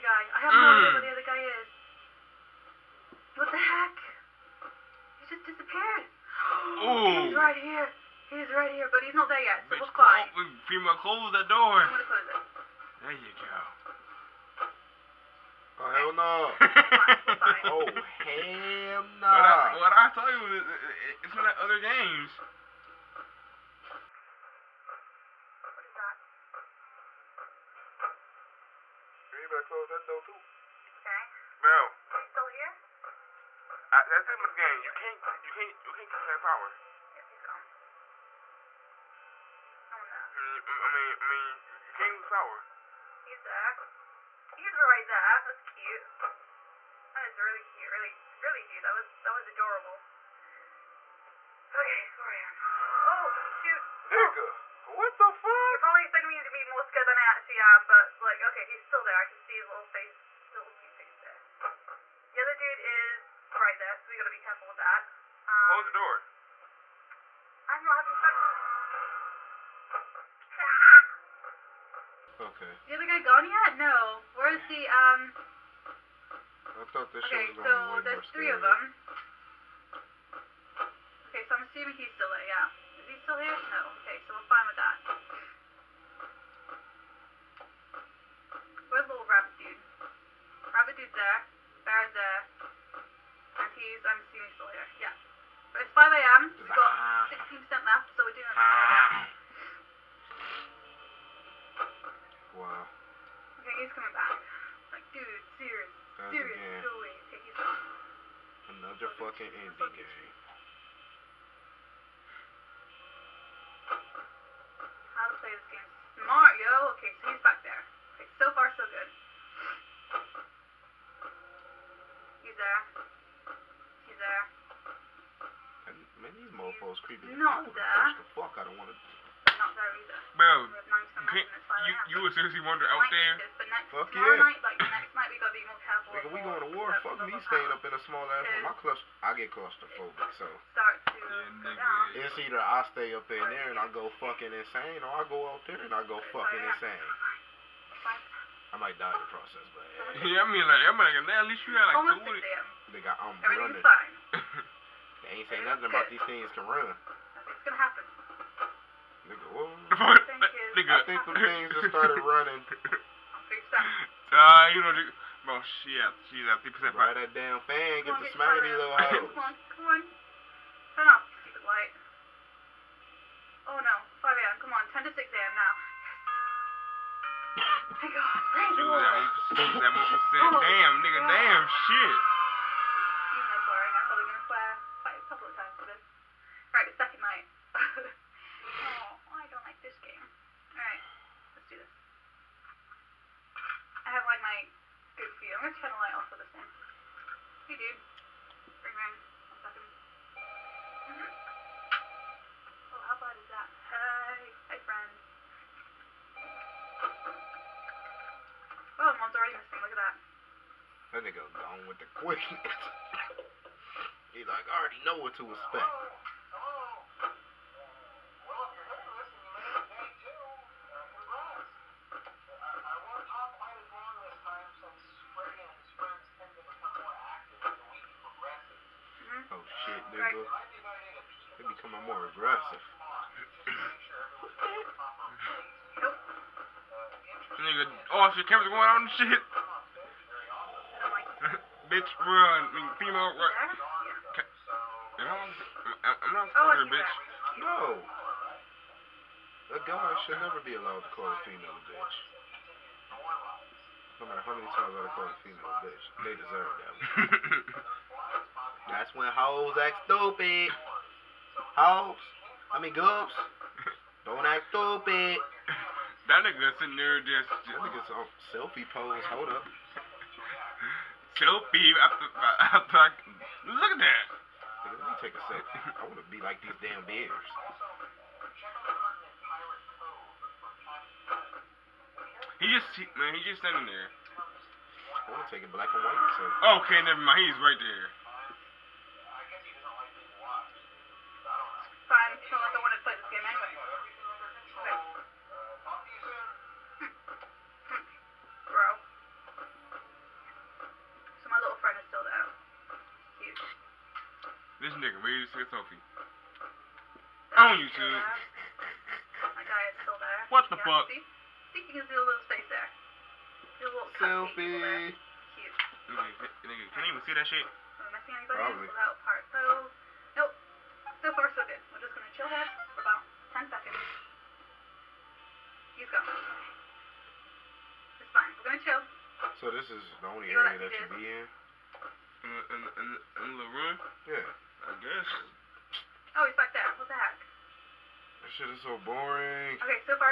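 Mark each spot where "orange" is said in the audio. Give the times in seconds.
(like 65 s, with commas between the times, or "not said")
195 s.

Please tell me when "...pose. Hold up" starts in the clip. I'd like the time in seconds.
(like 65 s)
268 s.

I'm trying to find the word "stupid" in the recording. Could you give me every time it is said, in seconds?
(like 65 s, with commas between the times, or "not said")
171 s, 260 s, 264 s.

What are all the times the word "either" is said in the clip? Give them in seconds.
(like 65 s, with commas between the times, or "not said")
129 s, 142 s.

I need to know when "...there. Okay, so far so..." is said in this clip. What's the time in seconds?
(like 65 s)
117 s.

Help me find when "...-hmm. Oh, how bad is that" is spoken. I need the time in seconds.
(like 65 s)
201 s.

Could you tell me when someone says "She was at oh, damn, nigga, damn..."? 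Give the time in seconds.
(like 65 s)
178 s.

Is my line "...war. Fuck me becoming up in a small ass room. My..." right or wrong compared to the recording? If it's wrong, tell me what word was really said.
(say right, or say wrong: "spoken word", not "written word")
wrong: "staying", not "becoming".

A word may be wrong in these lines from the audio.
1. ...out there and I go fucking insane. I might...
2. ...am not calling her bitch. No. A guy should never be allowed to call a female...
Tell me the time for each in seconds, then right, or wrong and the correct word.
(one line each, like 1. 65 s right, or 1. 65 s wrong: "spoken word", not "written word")
1. 145 s right
2. 245 s right.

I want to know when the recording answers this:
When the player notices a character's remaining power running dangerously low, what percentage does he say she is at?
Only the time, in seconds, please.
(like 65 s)
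166 s.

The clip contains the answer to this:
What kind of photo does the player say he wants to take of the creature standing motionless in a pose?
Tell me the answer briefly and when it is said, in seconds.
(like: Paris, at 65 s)
black and white, at 285 s.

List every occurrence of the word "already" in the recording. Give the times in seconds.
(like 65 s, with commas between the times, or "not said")
209 s, 214 s.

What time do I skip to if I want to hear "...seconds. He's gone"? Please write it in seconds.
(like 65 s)
323 s.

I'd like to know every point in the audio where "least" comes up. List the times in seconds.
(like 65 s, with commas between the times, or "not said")
151 s.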